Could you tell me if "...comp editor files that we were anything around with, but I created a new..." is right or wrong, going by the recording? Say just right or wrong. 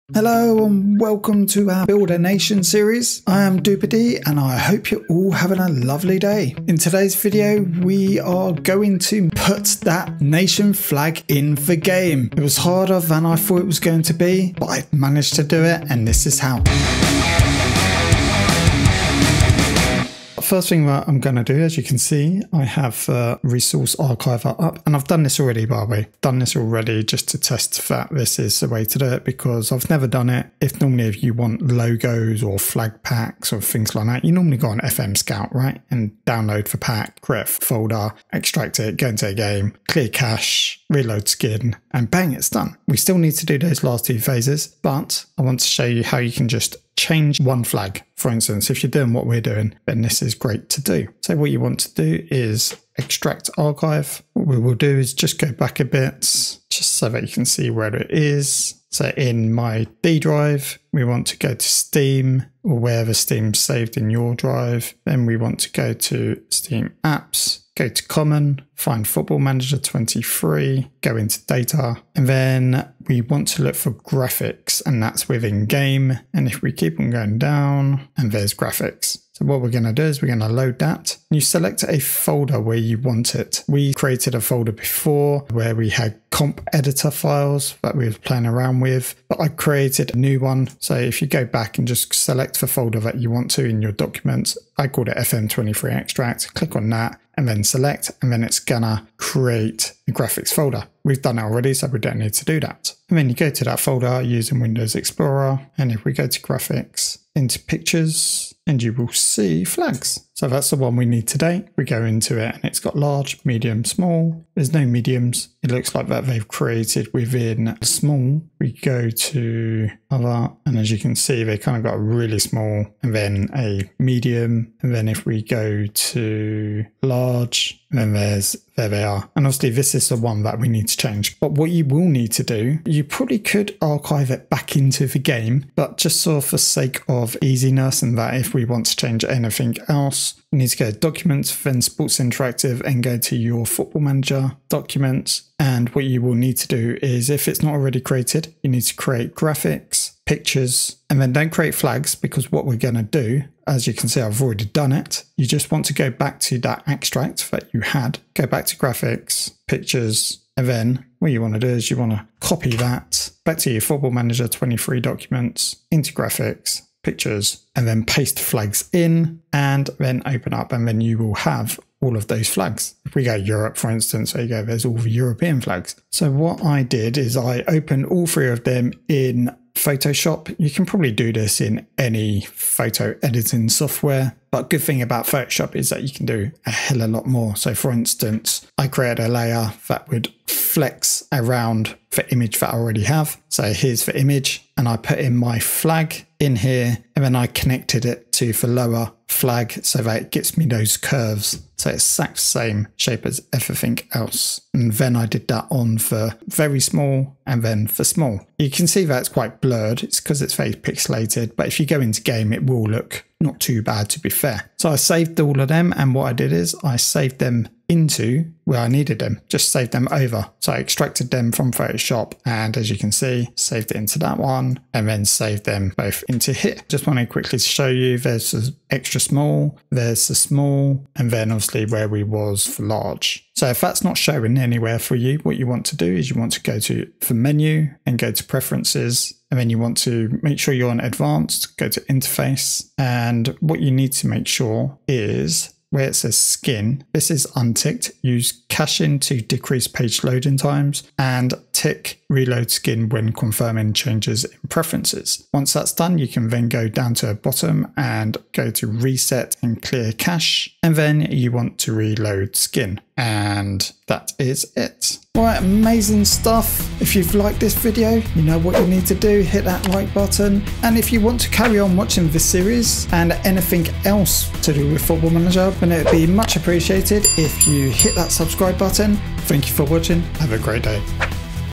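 wrong.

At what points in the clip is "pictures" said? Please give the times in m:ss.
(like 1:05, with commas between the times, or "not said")
1:47, 2:30, 2:39, 2:47.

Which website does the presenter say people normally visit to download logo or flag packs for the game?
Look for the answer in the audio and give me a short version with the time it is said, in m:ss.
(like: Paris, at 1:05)
FM Scout, at 0:34.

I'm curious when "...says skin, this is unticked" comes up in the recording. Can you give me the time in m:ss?
4:06.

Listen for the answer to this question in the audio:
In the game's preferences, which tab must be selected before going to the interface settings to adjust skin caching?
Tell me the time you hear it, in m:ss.
4:00.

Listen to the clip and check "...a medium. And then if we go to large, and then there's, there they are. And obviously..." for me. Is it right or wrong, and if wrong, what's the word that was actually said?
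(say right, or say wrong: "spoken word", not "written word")
right.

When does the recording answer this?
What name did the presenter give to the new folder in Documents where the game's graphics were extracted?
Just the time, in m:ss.
1:35.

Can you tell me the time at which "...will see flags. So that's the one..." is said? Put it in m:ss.
1:48.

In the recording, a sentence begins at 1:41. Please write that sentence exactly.
We've done already, so we don't need to do that.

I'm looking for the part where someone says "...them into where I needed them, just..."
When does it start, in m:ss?
3:37.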